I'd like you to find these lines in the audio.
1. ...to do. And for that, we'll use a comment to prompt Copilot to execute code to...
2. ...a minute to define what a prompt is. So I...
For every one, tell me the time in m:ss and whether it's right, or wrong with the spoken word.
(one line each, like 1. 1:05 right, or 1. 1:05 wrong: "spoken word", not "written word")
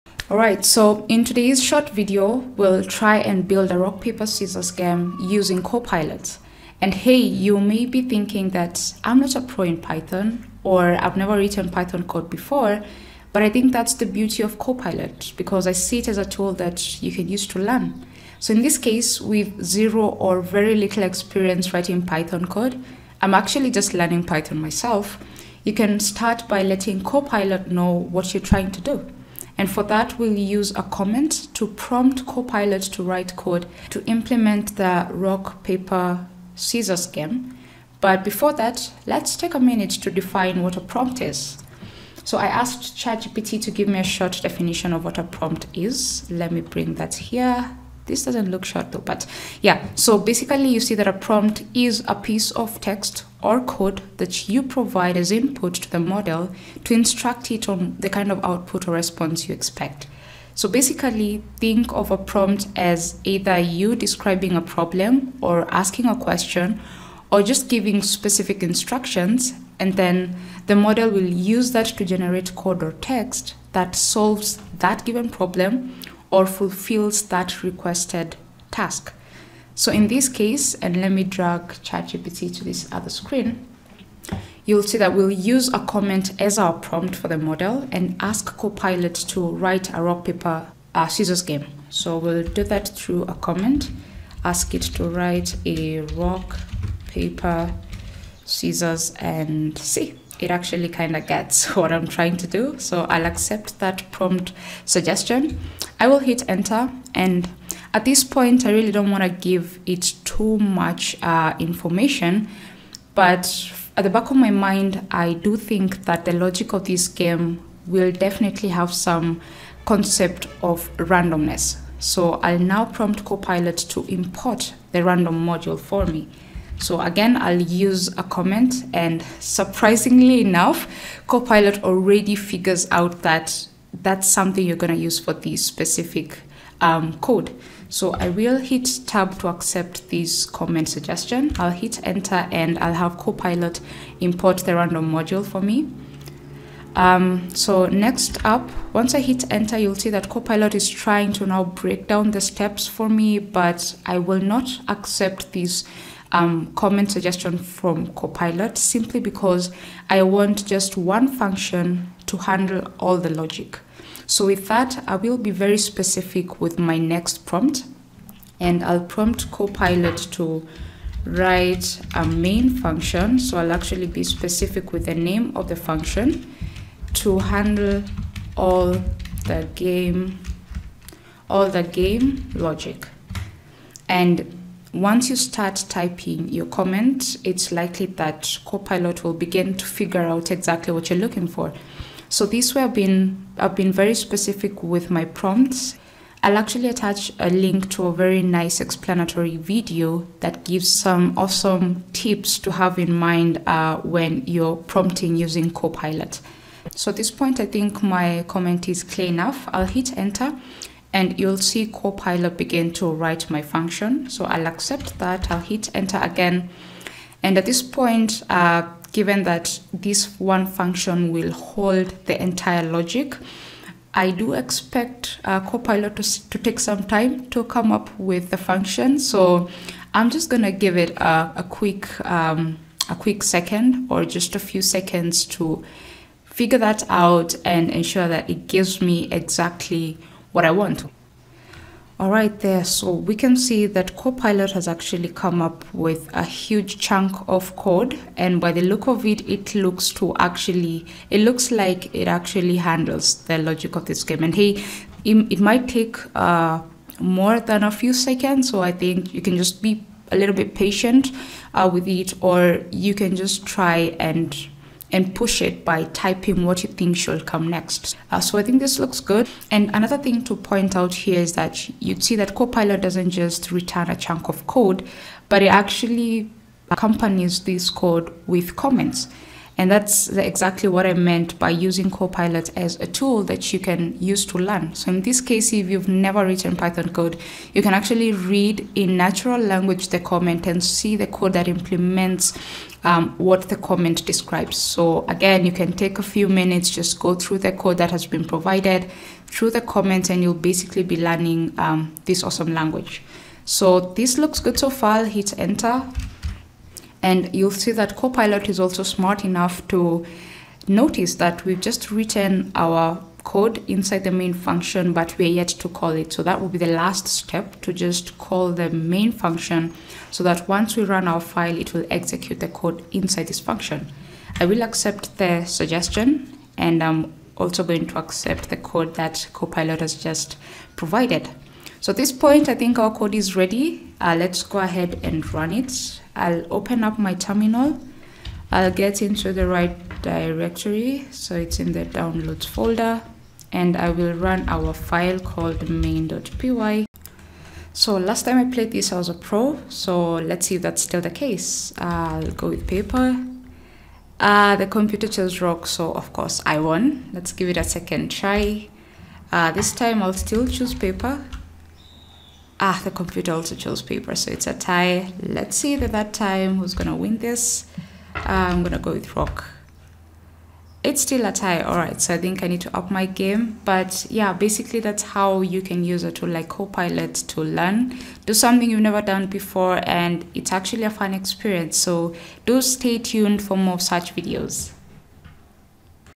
1. 0:28 wrong: "write", not "execute"
2. 0:39 right.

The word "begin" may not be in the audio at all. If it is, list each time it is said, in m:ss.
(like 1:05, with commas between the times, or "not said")
3:09, 3:32.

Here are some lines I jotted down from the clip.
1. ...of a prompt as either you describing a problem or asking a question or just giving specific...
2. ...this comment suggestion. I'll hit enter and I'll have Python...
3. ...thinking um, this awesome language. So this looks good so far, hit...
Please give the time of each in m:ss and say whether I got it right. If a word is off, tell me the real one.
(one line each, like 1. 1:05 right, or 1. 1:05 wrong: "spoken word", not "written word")
1. 1:01 right
2. 2:20 wrong: "Copilot", not "Python"
3. 5:01 wrong: "learning", not "thinking".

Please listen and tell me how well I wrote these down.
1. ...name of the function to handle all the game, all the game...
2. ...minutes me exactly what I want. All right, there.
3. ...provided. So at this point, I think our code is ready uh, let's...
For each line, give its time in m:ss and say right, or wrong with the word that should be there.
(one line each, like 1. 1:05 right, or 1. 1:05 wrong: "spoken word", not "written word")
1. 2:55 right
2. 3:58 wrong: "gives", not "minutes"
3. 5:30 right.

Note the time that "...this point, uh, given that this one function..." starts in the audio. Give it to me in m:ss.
3:37.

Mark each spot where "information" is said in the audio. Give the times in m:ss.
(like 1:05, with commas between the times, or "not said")
1:51.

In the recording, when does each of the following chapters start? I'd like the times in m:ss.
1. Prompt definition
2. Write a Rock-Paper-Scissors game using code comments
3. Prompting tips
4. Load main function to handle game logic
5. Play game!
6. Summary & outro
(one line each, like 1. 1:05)
1. 0:40
2. 1:33
3. 3:14
4. 3:54
5. 5:38
6. 6:15.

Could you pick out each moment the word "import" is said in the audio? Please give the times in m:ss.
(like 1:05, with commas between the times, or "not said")
2:04, 2:24.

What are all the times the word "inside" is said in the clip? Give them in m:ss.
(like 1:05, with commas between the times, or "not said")
5:13, 5:23.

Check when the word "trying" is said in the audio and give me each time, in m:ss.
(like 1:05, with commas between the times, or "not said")
0:28, 1:42, 2:30.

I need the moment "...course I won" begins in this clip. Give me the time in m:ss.
5:56.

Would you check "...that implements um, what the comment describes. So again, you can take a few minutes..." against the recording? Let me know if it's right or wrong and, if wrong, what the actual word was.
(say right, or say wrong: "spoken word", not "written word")
right.